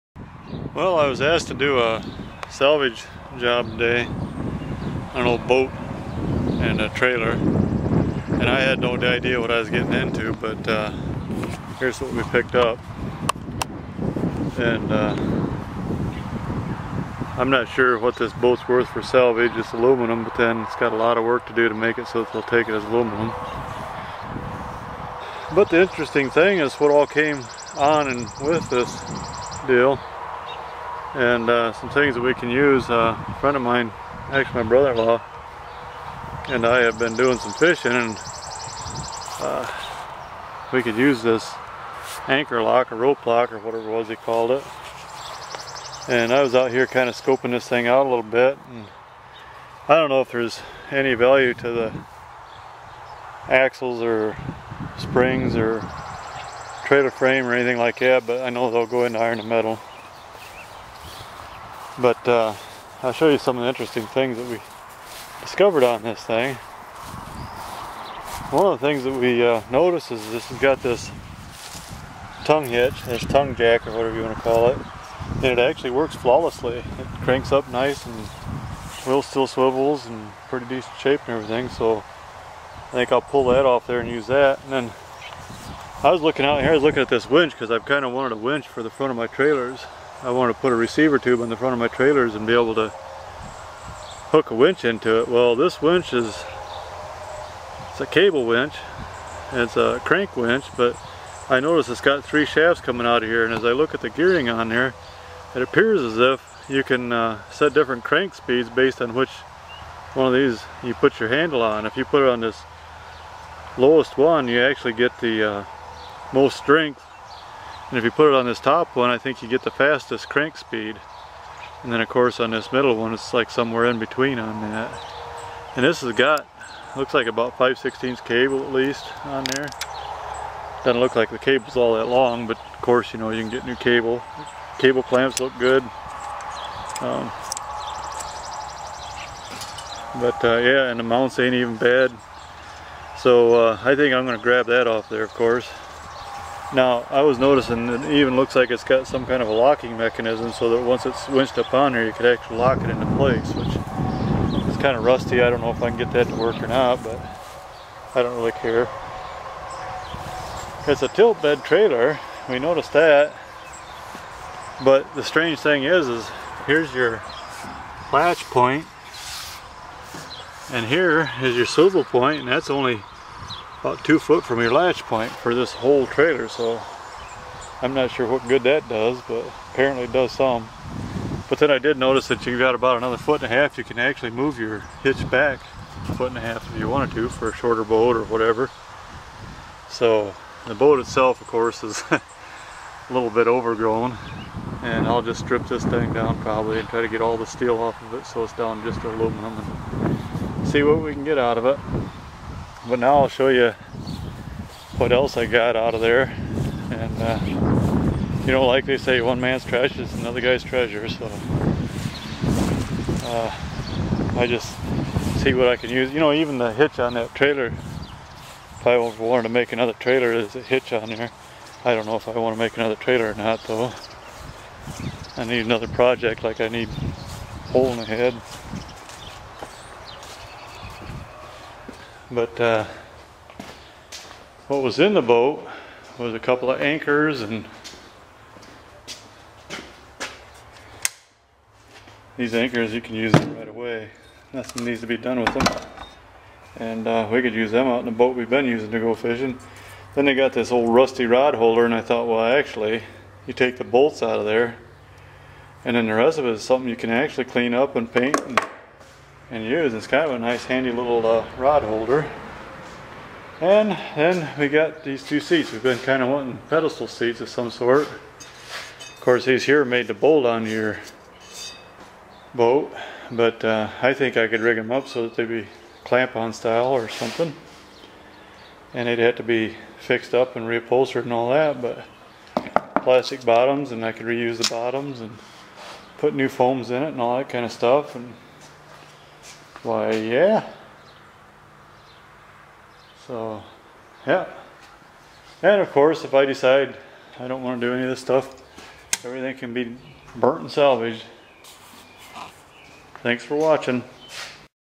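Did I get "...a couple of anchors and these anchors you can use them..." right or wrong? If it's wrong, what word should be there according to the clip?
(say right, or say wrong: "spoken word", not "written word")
right.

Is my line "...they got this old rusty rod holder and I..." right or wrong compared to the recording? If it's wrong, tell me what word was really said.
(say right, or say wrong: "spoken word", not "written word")
right.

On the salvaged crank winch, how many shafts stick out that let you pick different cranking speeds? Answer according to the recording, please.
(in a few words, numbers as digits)
3.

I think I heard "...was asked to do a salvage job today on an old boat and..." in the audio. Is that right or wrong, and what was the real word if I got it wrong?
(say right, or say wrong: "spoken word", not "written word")
right.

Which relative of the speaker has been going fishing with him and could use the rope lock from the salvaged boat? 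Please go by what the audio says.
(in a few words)
brother-in-law.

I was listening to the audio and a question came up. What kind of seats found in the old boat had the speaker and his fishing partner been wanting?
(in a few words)
pedestal seats.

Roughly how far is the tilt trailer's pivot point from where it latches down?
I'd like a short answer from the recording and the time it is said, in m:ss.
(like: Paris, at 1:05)
2 feet, at 2:54.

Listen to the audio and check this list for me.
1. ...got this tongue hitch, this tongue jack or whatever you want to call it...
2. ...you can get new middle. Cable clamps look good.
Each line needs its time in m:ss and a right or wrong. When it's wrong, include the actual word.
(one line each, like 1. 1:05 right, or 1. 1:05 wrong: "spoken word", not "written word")
1. 1:10 right
2. 2:13 wrong: "cable", not "middle".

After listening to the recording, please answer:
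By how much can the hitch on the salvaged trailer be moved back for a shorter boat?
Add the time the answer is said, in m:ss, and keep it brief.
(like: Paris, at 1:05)
a foot and a half, at 3:06.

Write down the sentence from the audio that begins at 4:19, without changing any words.
It's kind of a nice handy little uh, rod holder.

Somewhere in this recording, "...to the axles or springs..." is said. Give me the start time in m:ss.
0:51.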